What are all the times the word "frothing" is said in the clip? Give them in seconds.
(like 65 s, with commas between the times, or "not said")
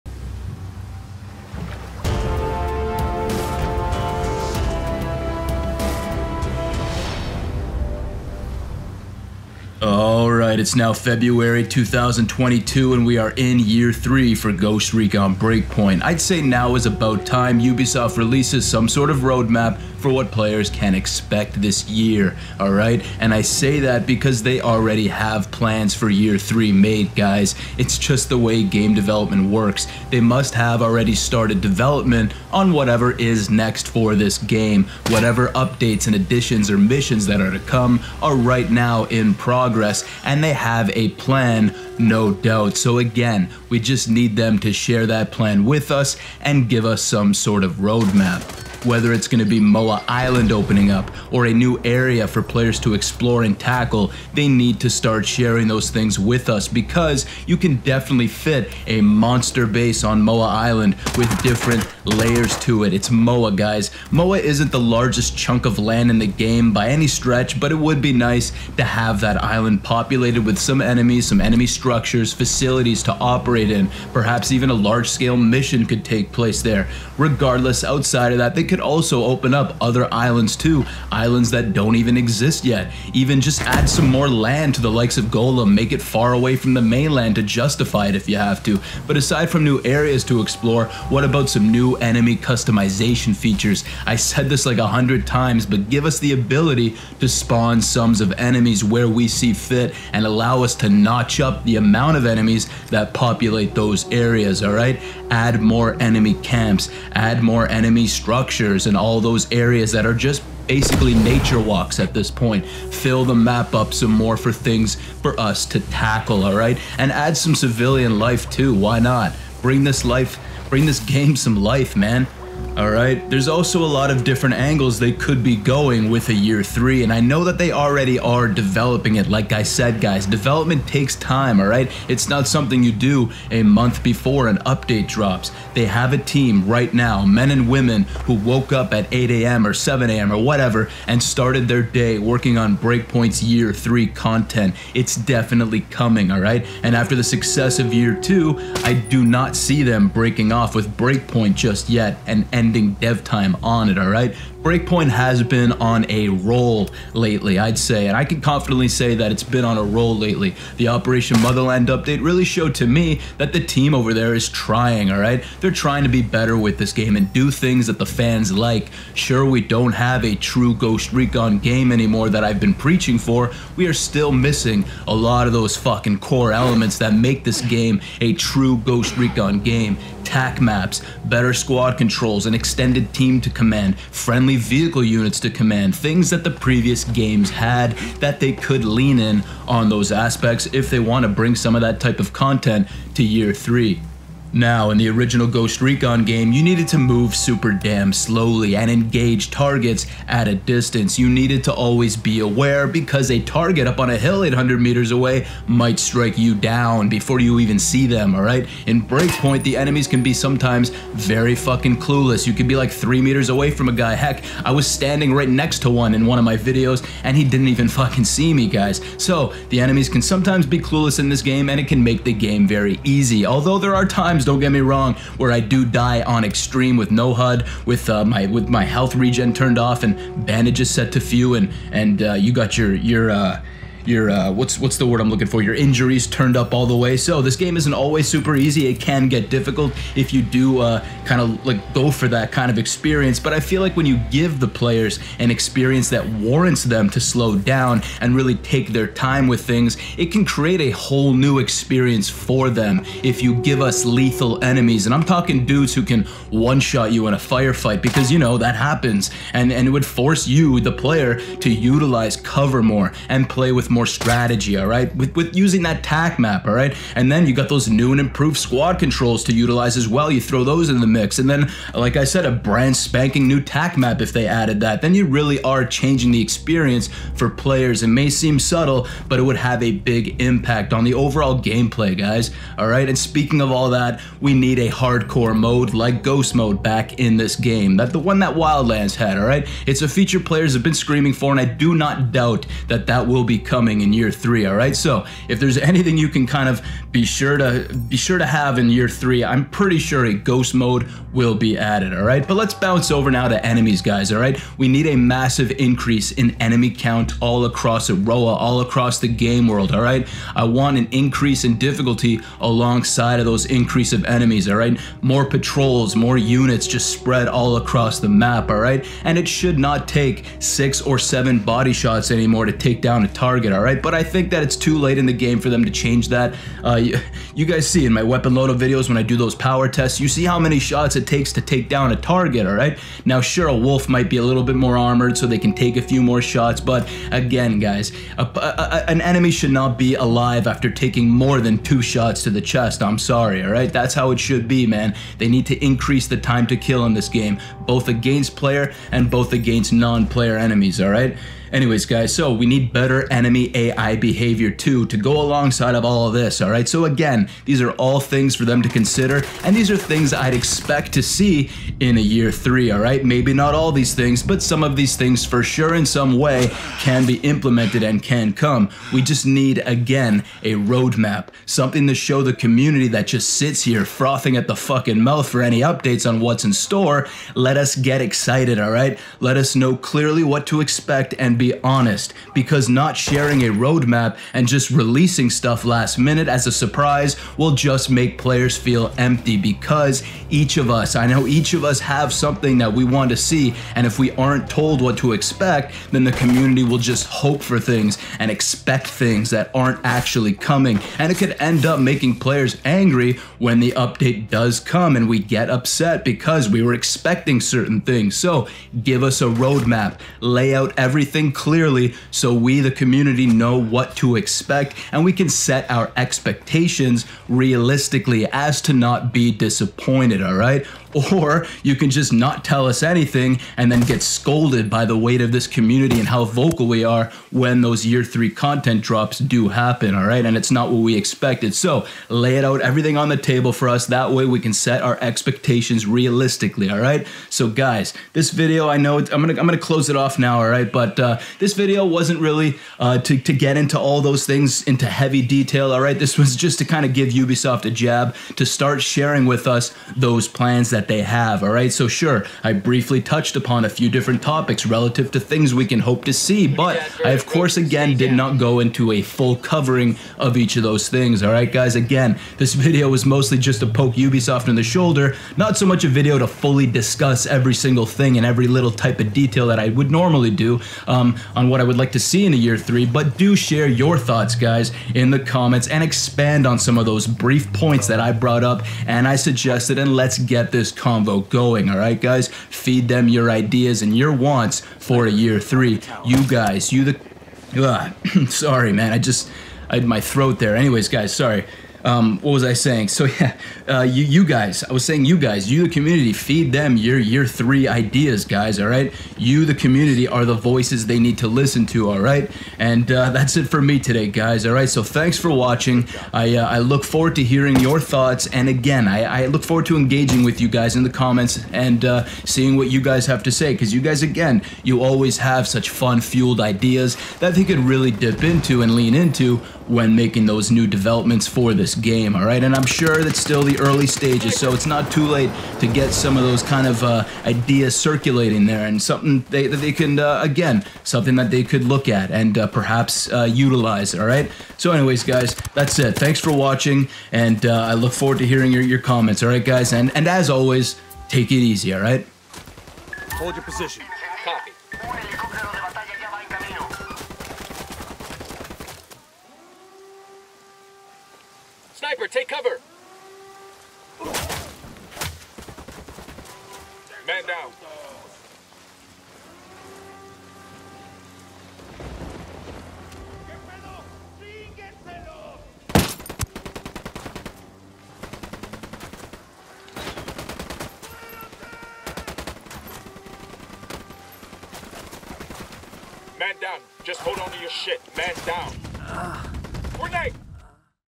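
374 s.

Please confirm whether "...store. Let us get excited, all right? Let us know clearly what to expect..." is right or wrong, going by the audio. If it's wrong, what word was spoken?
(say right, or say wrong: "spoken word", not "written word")
right.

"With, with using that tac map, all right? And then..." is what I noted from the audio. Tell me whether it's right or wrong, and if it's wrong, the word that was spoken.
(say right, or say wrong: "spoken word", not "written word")
right.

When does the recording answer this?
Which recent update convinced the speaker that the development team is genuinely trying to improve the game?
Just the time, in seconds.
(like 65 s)
160 s.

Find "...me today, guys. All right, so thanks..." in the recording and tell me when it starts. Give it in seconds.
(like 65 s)
503 s.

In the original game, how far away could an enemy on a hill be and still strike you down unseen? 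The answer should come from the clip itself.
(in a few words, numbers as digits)
800 meters.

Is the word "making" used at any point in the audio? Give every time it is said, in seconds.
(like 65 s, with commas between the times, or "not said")
401 s, 520 s.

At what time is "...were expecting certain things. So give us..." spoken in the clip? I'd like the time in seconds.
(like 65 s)
406 s.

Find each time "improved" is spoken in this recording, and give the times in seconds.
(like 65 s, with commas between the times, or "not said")
268 s.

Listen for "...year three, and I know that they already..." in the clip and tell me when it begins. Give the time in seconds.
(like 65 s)
126 s.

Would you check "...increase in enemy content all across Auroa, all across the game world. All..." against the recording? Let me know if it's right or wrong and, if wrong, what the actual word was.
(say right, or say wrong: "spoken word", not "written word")
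wrong: "count", not "content".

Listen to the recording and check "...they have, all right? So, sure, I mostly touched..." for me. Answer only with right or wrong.
wrong.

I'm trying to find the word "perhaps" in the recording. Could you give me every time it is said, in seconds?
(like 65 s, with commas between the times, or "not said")
74 s, 532 s.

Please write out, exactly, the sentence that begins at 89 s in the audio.
But aside from new areas to explore, what about some new enemy customization features?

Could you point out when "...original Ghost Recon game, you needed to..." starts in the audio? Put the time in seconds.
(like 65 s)
195 s.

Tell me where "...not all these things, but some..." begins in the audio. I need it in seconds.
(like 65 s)
363 s.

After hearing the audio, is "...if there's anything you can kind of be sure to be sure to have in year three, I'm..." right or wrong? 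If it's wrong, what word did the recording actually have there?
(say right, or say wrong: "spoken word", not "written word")
right.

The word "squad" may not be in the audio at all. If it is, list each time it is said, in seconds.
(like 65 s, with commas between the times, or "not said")
181 s, 268 s.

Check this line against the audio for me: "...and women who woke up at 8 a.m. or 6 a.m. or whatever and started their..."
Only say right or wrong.
wrong.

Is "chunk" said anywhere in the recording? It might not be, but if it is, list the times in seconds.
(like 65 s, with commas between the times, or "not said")
65 s.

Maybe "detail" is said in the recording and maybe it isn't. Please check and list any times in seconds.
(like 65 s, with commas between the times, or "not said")
445 s, 469 s.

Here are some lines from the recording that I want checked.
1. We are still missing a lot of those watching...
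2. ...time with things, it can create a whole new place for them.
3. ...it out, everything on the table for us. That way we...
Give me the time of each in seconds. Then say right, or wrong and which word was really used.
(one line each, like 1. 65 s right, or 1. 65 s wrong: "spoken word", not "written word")
1. 173 s wrong: "fucking", not "watching"
2. 249 s wrong: "experience", not "place"
3. 432 s right.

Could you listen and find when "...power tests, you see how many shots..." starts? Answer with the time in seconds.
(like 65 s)
329 s.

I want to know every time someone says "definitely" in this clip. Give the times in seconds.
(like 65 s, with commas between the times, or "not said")
57 s, 145 s.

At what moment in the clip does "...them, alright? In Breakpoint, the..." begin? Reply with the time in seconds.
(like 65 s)
208 s.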